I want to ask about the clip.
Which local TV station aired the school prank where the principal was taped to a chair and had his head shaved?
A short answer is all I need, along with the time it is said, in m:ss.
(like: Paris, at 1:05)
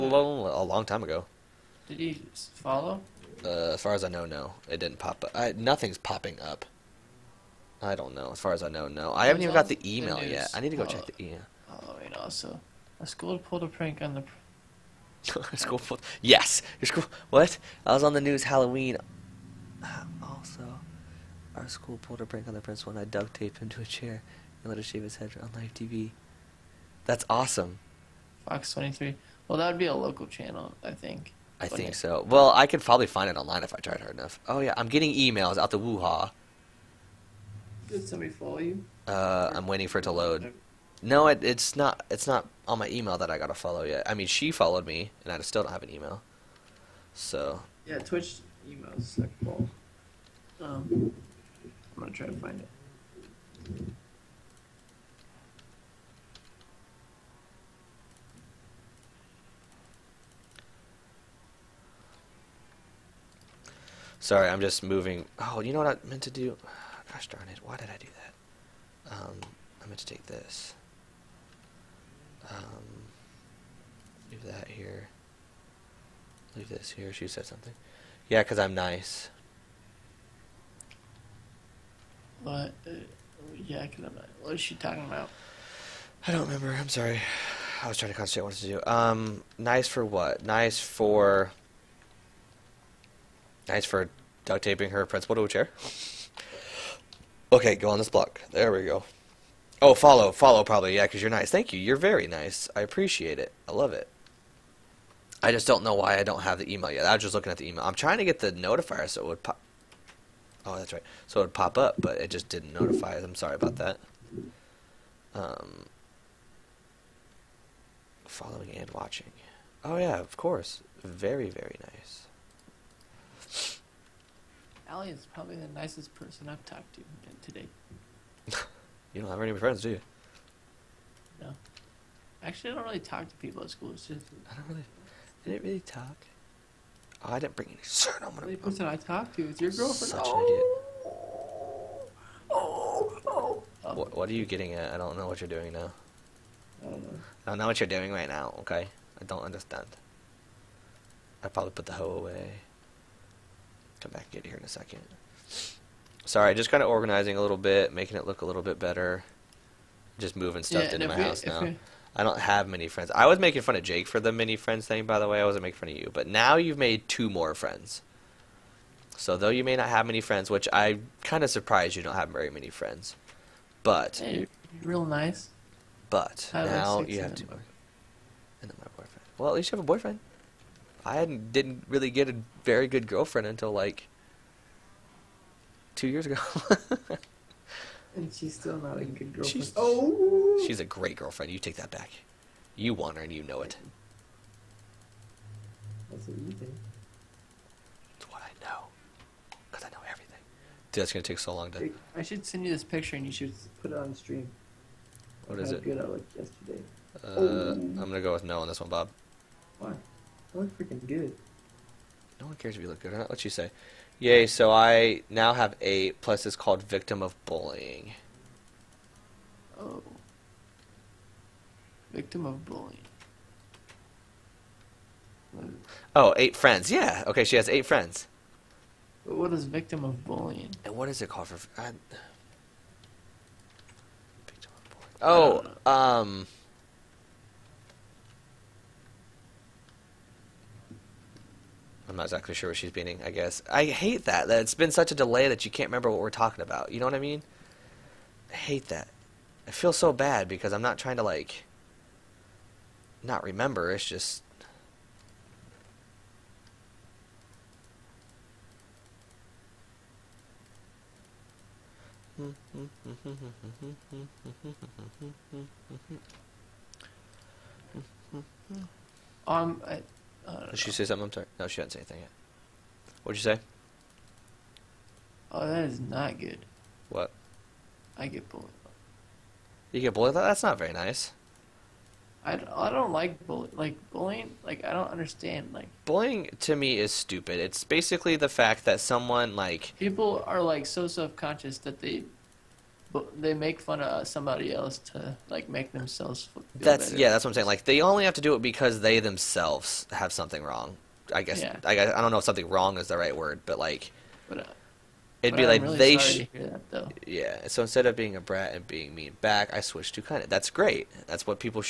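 Fox 23, at 0:28.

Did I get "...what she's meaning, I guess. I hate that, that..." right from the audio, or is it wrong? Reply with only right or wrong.
right.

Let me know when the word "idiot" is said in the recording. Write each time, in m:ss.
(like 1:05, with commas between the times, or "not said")
2:20.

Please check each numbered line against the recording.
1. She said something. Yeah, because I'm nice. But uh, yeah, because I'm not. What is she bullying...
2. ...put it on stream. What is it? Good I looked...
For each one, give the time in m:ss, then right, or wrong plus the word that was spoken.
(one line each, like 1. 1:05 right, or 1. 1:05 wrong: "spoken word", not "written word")
1. 1:17 wrong: "talking", not "bullying"
2. 3:23 right.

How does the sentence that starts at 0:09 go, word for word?
I haven't even got the email the yet.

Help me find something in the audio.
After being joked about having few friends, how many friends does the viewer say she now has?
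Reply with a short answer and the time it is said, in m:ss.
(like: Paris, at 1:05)
8, at 3:35.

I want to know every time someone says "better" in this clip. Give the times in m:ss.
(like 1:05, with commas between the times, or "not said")
2:38, 4:57.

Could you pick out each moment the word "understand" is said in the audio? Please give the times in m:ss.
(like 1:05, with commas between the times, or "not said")
2:29, 4:45.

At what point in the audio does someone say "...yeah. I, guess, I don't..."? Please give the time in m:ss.
5:01.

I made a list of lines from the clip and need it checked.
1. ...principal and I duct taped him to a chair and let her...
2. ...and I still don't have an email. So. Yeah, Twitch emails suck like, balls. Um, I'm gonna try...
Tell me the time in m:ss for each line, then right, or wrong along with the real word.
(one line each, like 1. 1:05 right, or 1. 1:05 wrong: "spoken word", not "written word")
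1. 0:22 right
2. 0:45 right.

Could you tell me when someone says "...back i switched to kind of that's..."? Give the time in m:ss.
5:09.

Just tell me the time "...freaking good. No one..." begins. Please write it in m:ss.
3:30.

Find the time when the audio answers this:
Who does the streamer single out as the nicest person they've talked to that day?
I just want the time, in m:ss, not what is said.
2:04.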